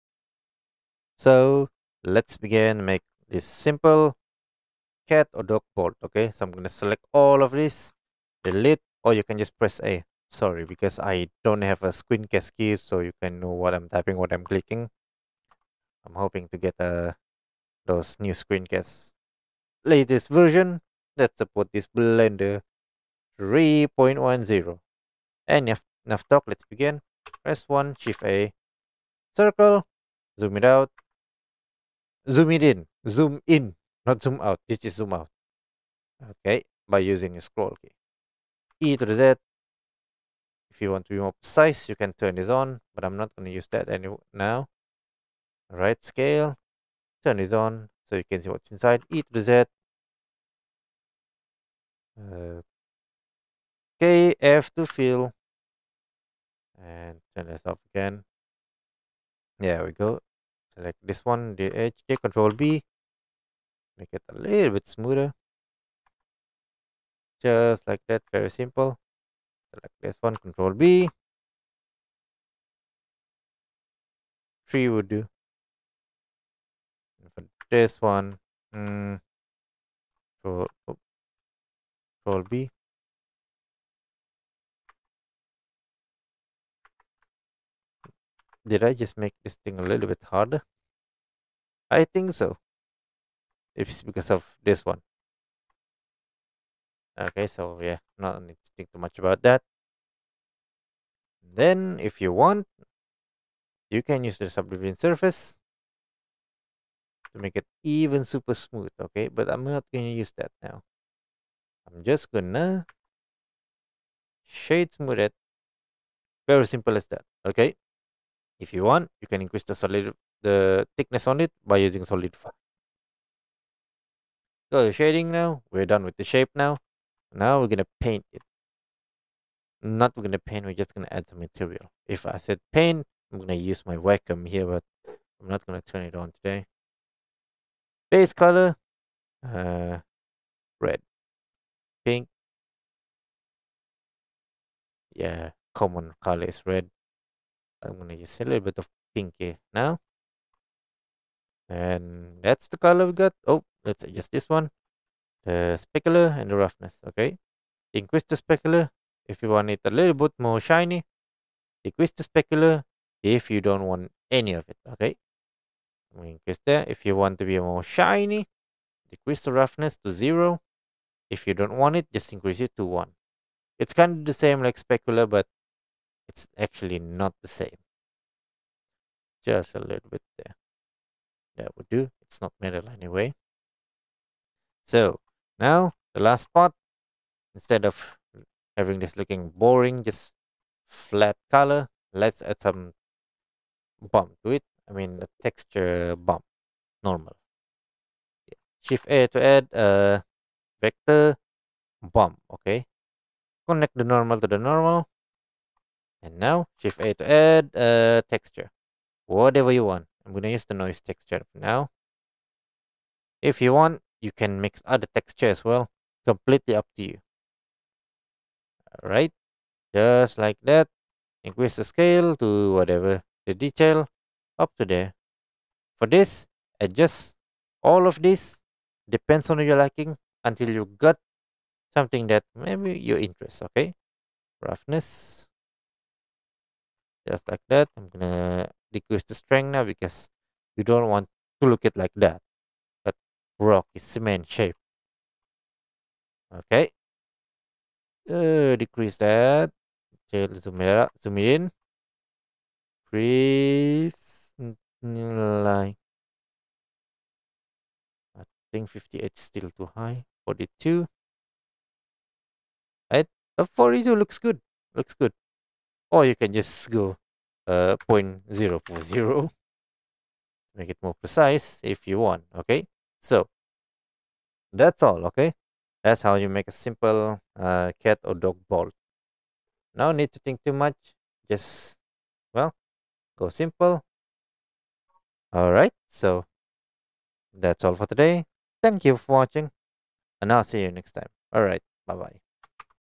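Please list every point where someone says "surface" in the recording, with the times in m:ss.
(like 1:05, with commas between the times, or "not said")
1:44.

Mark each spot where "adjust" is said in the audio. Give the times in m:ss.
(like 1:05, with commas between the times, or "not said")
2:34, 3:46.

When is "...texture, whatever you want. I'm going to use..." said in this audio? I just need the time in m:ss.
3:28.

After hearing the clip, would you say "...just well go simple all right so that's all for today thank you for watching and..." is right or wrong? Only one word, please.
right.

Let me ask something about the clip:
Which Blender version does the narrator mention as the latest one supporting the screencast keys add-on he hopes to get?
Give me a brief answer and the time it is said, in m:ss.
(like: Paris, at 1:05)
3.10, at 0:21.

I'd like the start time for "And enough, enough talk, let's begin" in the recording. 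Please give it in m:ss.
0:25.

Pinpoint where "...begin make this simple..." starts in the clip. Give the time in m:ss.
0:02.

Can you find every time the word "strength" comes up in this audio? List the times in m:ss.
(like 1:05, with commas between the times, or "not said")
3:59.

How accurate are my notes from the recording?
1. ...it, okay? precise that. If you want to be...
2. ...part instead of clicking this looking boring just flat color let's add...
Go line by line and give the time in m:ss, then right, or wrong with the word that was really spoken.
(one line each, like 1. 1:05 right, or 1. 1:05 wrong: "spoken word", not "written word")
1. 2:44 wrong: "increase", not "precise"
2. 3:06 wrong: "having", not "clicking".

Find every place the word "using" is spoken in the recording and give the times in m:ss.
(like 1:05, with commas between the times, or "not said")
0:36, 2:01.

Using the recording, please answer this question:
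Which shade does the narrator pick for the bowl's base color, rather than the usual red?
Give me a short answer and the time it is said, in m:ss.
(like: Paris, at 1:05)
Pink, at 2:29.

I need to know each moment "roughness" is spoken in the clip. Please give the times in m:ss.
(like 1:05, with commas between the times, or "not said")
2:36, 2:49, 3:54.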